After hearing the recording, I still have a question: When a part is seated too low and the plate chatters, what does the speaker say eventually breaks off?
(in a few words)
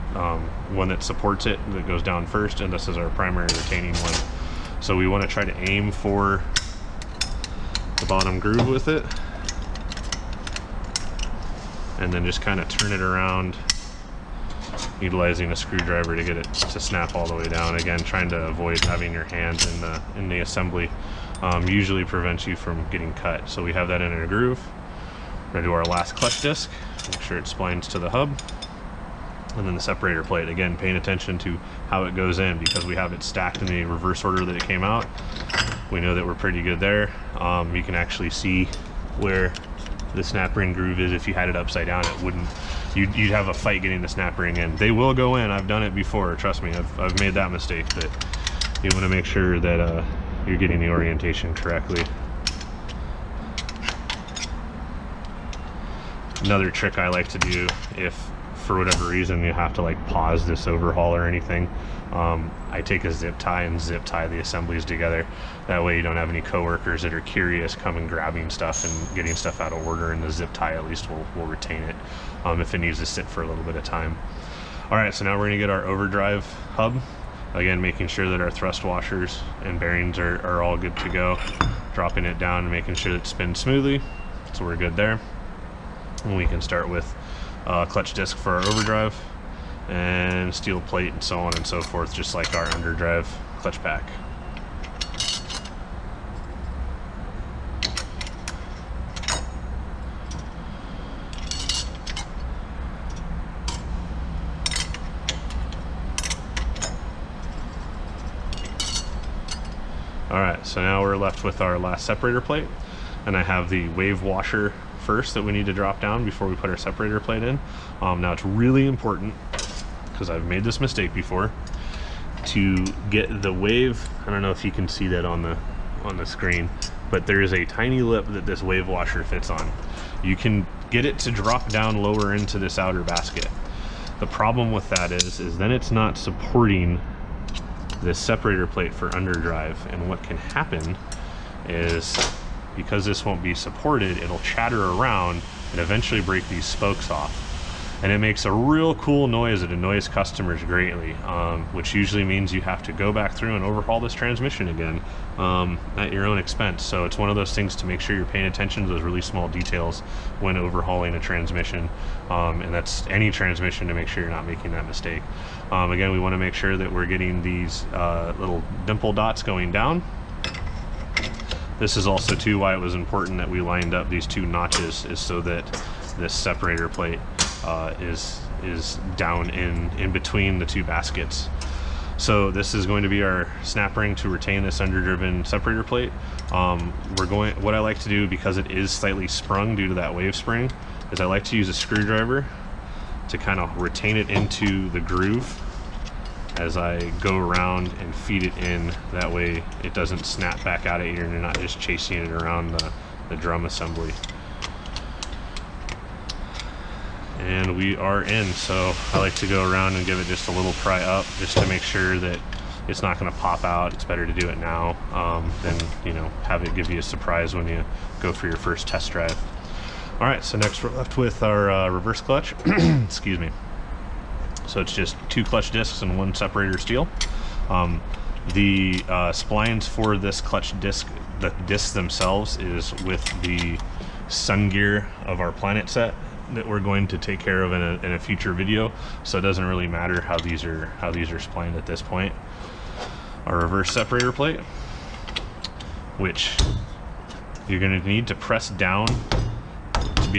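spokes.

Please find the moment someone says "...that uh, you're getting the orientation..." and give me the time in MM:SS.
00:49.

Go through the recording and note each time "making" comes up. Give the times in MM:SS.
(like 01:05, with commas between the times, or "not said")
01:17, 01:22, 02:44.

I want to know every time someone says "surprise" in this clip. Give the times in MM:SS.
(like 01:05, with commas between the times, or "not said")
03:37.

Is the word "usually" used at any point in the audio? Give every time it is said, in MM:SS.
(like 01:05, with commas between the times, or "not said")
00:21, 02:31.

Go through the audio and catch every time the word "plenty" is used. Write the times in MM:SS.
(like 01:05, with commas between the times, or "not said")
not said.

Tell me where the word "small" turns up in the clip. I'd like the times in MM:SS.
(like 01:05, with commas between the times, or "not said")
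02:39.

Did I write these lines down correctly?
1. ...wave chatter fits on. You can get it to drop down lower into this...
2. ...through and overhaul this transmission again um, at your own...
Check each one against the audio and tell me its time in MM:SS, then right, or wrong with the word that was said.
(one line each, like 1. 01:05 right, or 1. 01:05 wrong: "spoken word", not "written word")
1. 02:08 wrong: "washer", not "chatter"
2. 02:33 right.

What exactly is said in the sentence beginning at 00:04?
So we want to try to aim for bottom groove with it.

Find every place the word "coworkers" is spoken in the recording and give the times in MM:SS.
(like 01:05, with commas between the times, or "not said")
01:06.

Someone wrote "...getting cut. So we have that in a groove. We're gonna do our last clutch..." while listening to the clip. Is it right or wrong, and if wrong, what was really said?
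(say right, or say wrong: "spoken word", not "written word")
right.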